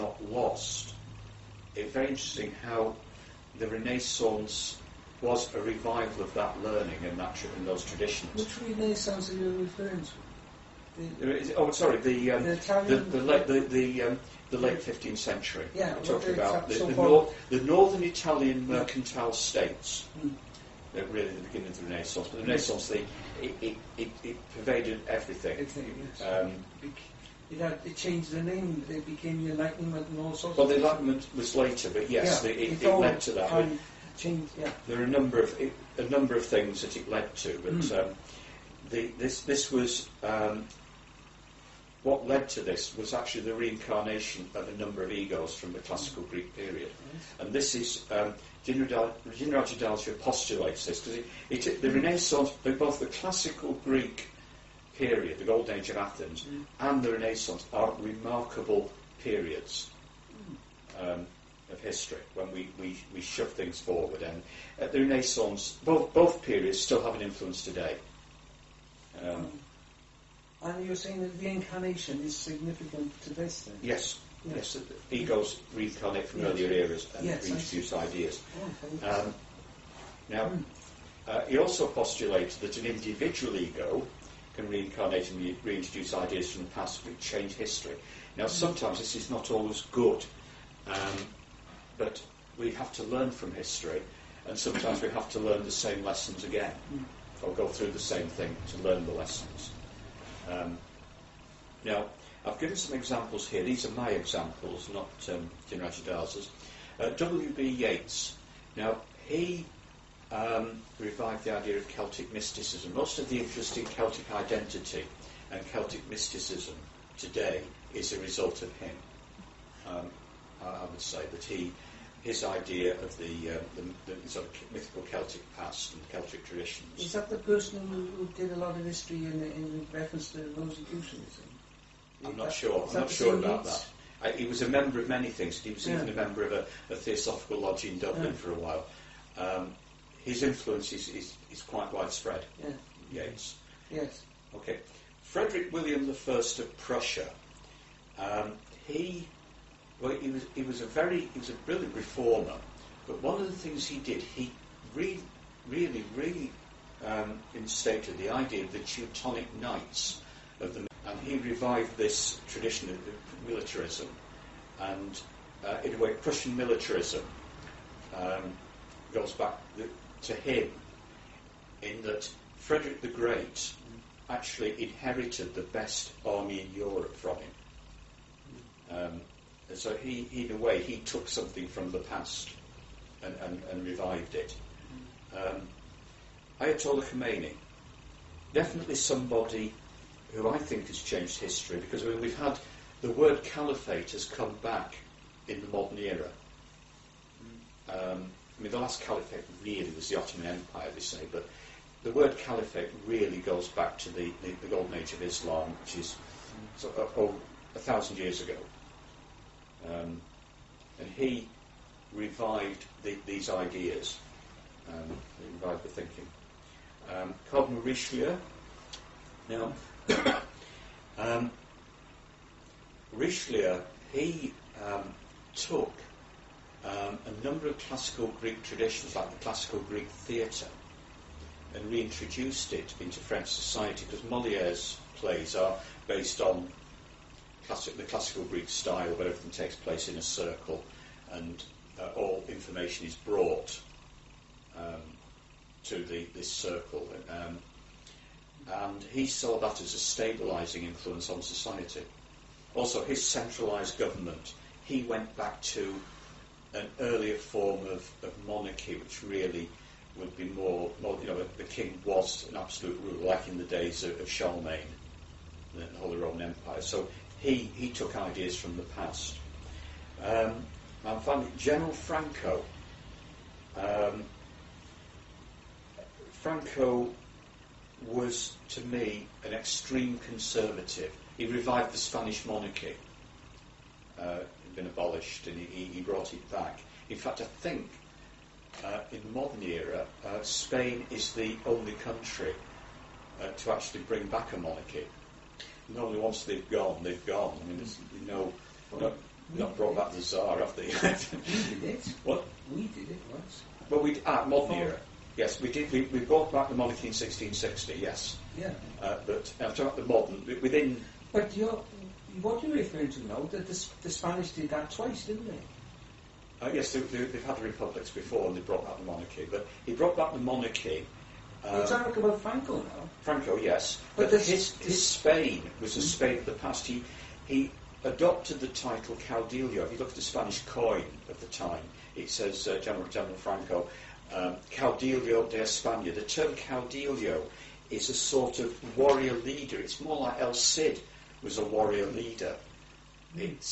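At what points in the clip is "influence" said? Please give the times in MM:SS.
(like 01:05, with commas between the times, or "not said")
01:07, 02:20, 04:10.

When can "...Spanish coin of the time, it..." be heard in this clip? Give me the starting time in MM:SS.
05:30.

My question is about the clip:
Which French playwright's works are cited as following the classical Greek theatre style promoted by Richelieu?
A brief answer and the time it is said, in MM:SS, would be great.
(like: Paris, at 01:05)
Moliere, at 03:54.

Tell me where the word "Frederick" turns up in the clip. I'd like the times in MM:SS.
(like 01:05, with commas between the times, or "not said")
02:25, 02:52.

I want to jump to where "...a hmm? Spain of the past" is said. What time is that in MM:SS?
05:25.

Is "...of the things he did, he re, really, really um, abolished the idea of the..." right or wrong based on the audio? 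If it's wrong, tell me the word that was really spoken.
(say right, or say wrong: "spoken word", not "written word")
wrong: "instated", not "abolished".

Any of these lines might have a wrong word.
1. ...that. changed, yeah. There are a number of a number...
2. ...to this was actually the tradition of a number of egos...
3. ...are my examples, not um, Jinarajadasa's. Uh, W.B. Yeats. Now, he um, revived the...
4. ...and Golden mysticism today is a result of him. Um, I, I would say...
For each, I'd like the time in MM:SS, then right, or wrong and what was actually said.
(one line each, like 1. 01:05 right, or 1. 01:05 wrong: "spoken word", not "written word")
1. 00:33 right
2. 00:42 wrong: "reincarnation", not "tradition"
3. 01:43 right
4. 01:55 wrong: "Celtic", not "Golden".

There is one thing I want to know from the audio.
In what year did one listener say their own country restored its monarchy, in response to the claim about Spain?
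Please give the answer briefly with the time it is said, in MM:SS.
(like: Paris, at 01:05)
1660, at 05:07.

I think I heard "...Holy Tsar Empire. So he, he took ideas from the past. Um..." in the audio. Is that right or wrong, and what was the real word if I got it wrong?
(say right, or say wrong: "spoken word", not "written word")
wrong: "Roman", not "Tsar".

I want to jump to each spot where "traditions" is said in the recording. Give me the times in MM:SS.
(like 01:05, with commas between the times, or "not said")
00:07, 02:06, 02:42, 03:48.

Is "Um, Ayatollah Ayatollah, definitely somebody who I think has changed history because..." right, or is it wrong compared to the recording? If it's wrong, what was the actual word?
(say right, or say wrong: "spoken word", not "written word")
wrong: "Khomeini", not "Ayatollah".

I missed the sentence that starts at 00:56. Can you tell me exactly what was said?
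and the Renaissance are remarkable periods mm.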